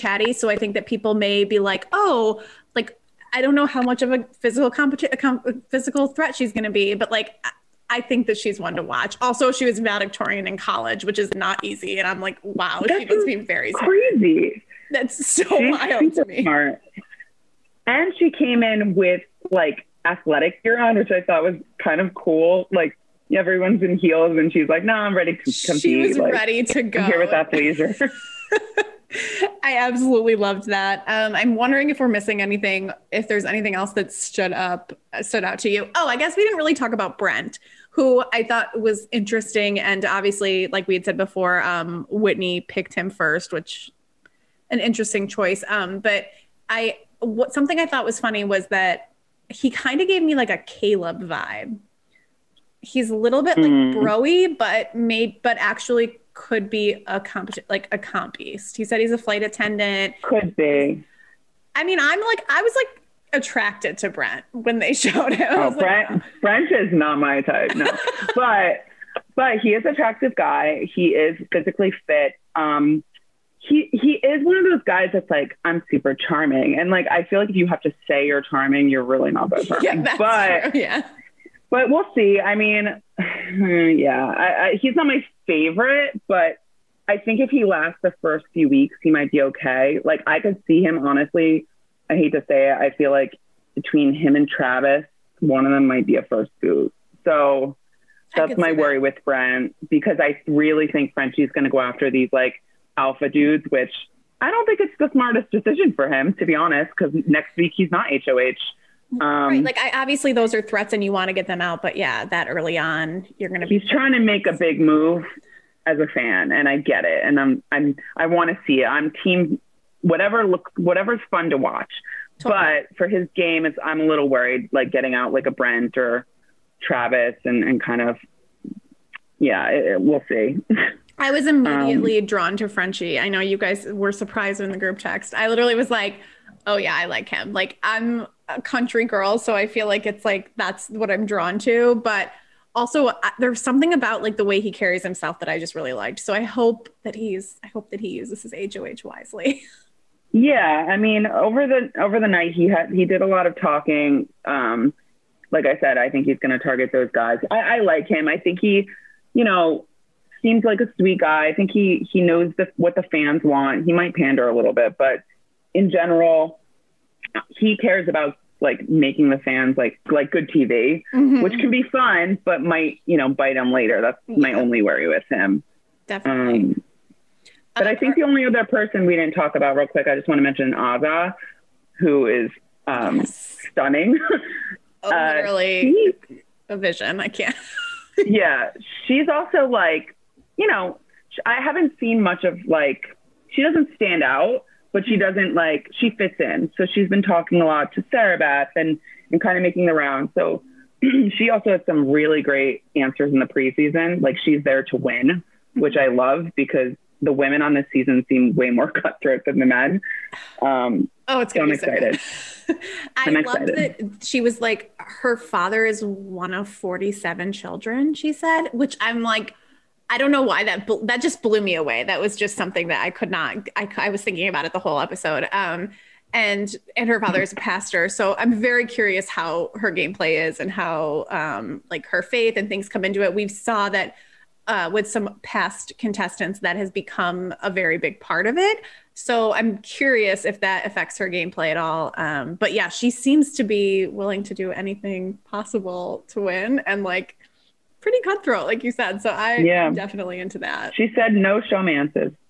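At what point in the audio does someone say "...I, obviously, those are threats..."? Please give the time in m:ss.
1:49.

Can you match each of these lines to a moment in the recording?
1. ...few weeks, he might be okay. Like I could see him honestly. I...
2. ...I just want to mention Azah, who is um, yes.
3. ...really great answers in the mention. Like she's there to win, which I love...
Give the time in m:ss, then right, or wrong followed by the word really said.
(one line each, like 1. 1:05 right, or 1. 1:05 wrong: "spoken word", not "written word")
1. 1:28 right
2. 3:00 right
3. 3:22 wrong: "preseason", not "mention".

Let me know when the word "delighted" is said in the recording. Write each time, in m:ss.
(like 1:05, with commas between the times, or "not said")
not said.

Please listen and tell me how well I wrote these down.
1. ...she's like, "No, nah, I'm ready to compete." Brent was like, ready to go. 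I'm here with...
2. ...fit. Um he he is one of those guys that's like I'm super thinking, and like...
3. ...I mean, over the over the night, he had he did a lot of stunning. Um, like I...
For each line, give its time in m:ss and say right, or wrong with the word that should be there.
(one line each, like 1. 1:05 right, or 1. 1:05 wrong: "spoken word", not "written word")
1. 0:24 wrong: "She", not "Brent"
2. 1:12 wrong: "charming", not "thinking"
3. 2:30 wrong: "talking", not "stunning".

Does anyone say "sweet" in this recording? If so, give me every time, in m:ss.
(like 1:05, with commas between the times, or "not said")
2:40.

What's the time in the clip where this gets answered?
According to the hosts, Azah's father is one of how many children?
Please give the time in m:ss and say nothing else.
3:36.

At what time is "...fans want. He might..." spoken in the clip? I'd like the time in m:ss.
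2:43.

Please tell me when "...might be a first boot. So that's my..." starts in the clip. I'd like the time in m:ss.
1:35.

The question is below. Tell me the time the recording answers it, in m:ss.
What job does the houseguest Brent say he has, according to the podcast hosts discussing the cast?
0:59.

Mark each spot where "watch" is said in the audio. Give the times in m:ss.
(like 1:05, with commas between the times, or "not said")
0:08, 2:01.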